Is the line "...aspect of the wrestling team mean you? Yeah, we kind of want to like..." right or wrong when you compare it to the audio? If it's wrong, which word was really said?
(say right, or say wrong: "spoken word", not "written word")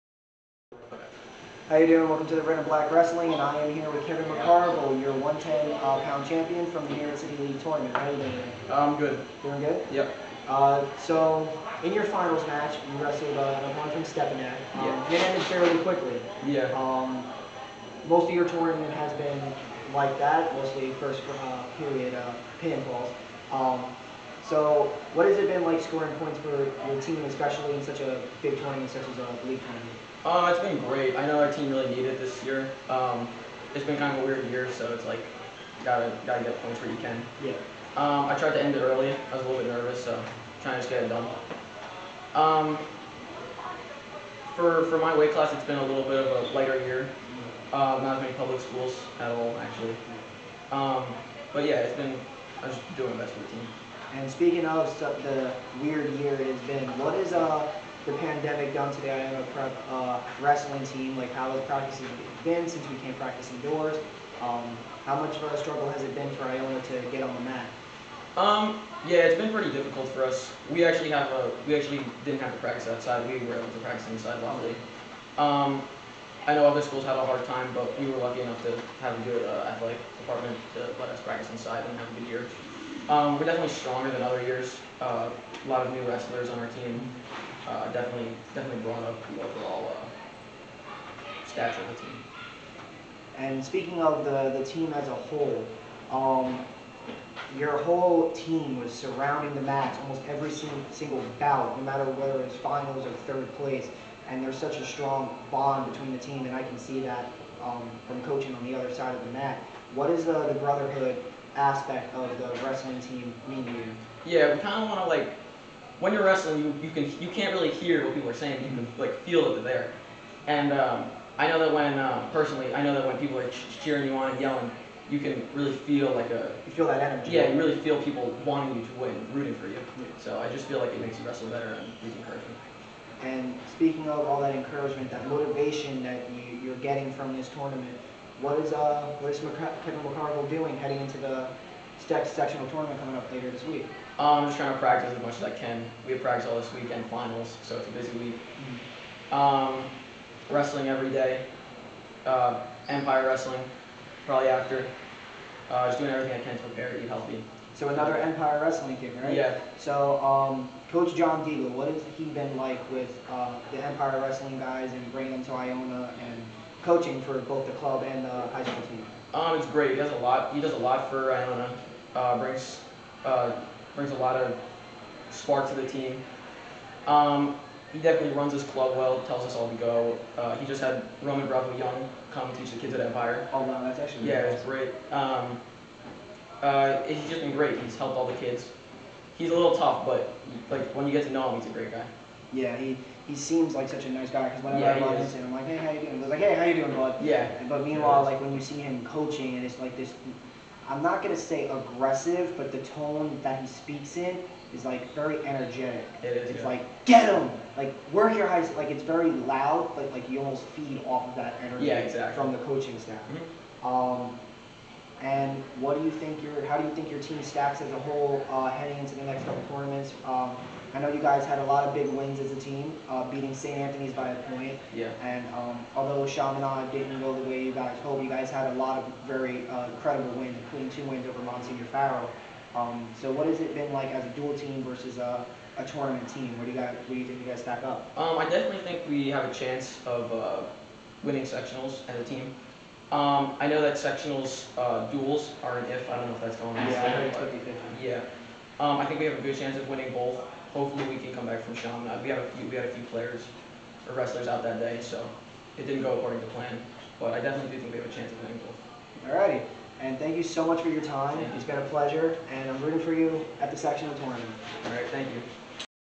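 right.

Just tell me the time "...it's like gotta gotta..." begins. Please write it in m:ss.
0:34.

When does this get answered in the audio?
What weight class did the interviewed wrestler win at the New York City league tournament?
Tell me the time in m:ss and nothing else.
0:05.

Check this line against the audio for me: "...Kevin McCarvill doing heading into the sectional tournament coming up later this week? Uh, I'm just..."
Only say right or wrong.
right.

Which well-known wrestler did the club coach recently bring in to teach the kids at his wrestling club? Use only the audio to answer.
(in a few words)
Roman Bravo Young.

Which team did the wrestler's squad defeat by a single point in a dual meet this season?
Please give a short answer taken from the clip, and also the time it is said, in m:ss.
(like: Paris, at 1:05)
St. Anthony's, at 3:43.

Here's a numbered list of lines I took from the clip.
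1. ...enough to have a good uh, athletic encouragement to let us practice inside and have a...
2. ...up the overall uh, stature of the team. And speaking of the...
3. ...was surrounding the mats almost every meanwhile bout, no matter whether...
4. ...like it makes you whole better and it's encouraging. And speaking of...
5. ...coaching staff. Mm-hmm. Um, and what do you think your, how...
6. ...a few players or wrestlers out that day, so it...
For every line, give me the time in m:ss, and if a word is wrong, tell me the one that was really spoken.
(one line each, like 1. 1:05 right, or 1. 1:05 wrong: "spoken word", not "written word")
1. 1:18 wrong: "department", not "encouragement"
2. 1:29 right
3. 1:38 wrong: "single", not "meanwhile"
4. 2:10 wrong: "wrestle", not "whole"
5. 3:32 right
6. 4:12 right.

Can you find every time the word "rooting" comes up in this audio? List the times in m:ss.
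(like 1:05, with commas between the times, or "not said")
2:09, 4:22.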